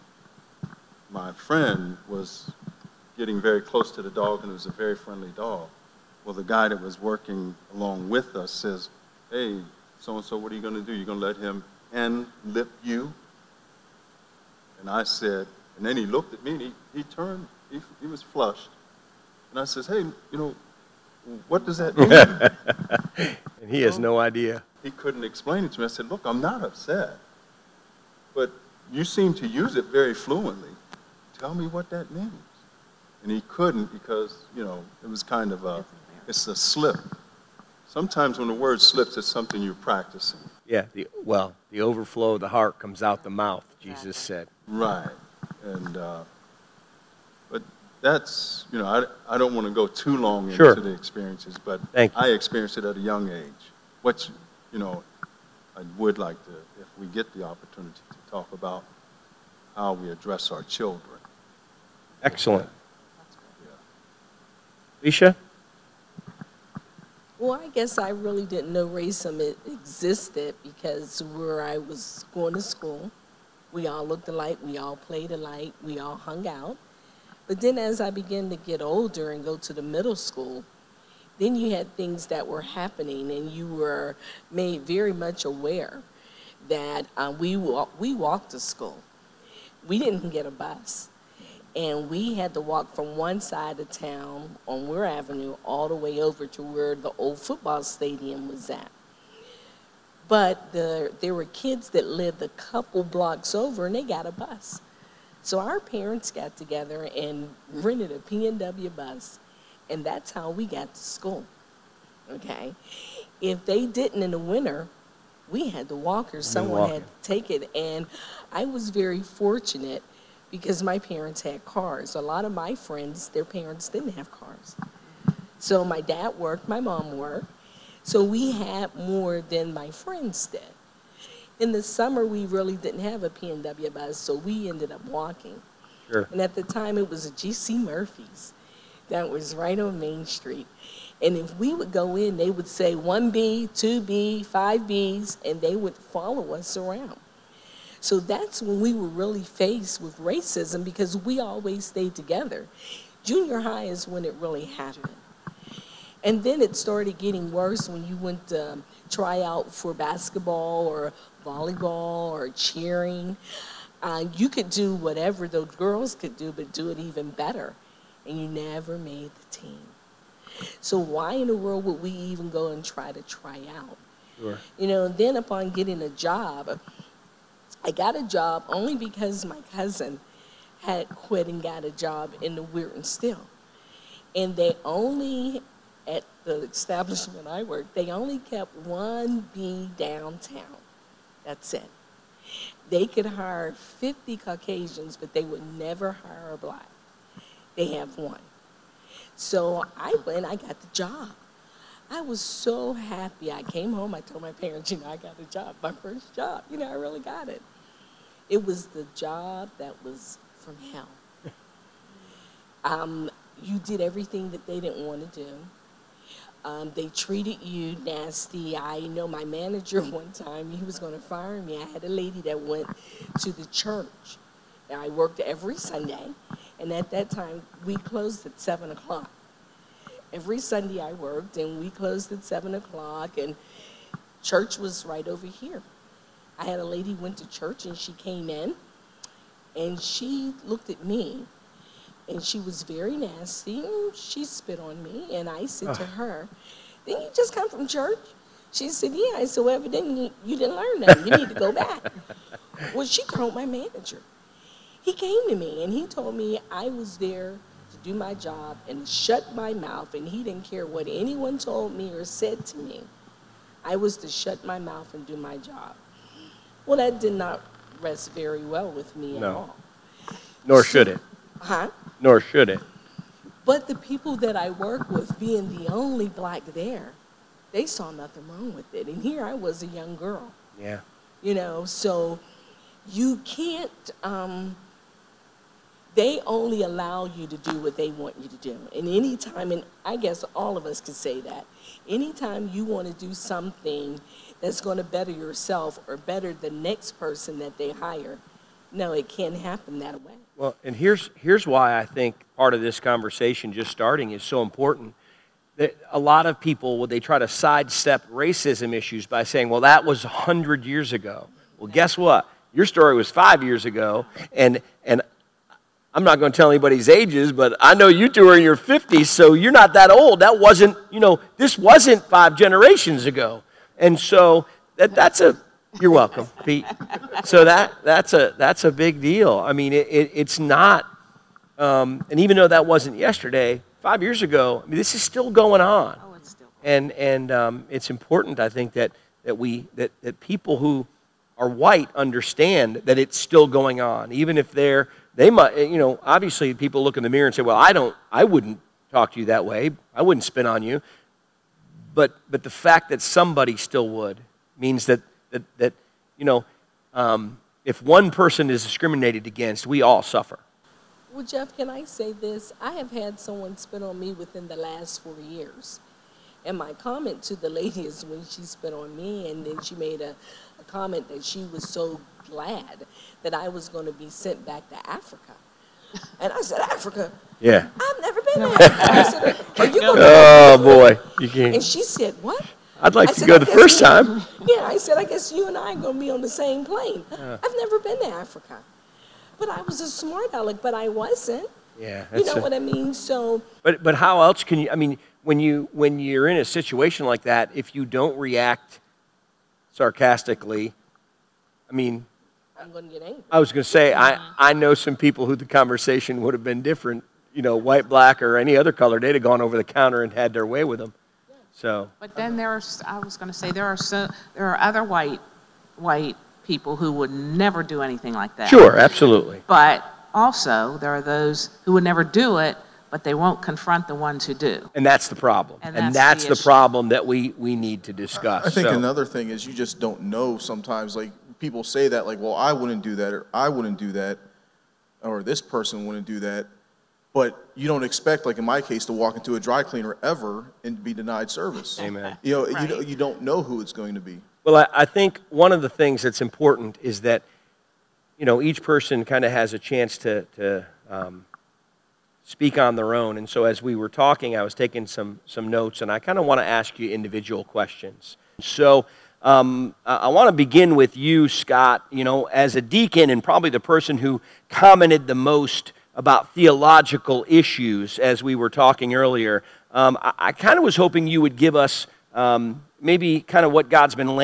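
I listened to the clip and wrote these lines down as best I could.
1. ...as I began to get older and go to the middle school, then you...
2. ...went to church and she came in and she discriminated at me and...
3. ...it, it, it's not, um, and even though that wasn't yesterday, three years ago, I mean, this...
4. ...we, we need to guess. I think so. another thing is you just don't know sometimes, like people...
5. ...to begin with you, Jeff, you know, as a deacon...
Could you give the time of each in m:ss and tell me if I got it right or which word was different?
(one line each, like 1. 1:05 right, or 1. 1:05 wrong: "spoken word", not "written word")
1. 1:17 right
2. 3:57 wrong: "looked", not "discriminated"
3. 5:29 wrong: "five", not "three"
4. 7:07 wrong: "discuss", not "guess"
5. 7:40 wrong: "Scott", not "Jeff".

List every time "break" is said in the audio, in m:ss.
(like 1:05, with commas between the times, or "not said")
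not said.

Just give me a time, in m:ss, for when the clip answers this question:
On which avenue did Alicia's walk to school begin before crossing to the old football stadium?
1:34.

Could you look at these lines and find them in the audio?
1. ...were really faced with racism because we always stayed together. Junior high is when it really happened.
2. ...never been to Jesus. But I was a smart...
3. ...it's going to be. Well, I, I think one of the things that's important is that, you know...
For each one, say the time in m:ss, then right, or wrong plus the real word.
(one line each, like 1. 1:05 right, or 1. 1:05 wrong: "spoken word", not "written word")
1. 2:28 right
2. 6:27 wrong: "Africa", not "Jesus"
3. 7:23 right.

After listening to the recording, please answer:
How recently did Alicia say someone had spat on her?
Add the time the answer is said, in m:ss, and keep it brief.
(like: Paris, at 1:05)
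4 years, at 6:05.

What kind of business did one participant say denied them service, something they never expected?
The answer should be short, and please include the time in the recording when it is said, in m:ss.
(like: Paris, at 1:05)
dry cleaner, at 7:19.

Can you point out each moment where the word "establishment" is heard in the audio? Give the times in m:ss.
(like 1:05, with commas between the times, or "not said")
3:06.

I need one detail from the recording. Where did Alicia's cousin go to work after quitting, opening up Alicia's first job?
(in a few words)
Weirton Steel.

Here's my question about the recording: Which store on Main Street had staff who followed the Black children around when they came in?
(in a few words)
GC Murphy's.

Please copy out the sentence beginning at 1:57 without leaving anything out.
And I was very fortunate because my parents had cars.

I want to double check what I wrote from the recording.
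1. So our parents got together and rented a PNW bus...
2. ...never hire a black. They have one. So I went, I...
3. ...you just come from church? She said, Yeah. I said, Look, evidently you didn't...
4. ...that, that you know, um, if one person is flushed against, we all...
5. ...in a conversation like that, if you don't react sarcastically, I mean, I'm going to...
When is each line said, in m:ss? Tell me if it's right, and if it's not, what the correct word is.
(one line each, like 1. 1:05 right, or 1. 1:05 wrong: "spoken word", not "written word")
1. 1:45 right
2. 3:15 right
3. 4:07 wrong: "Well", not "Look"
4. 5:55 wrong: "discriminated", not "flushed"
5. 6:36 wrong: "situation", not "conversation".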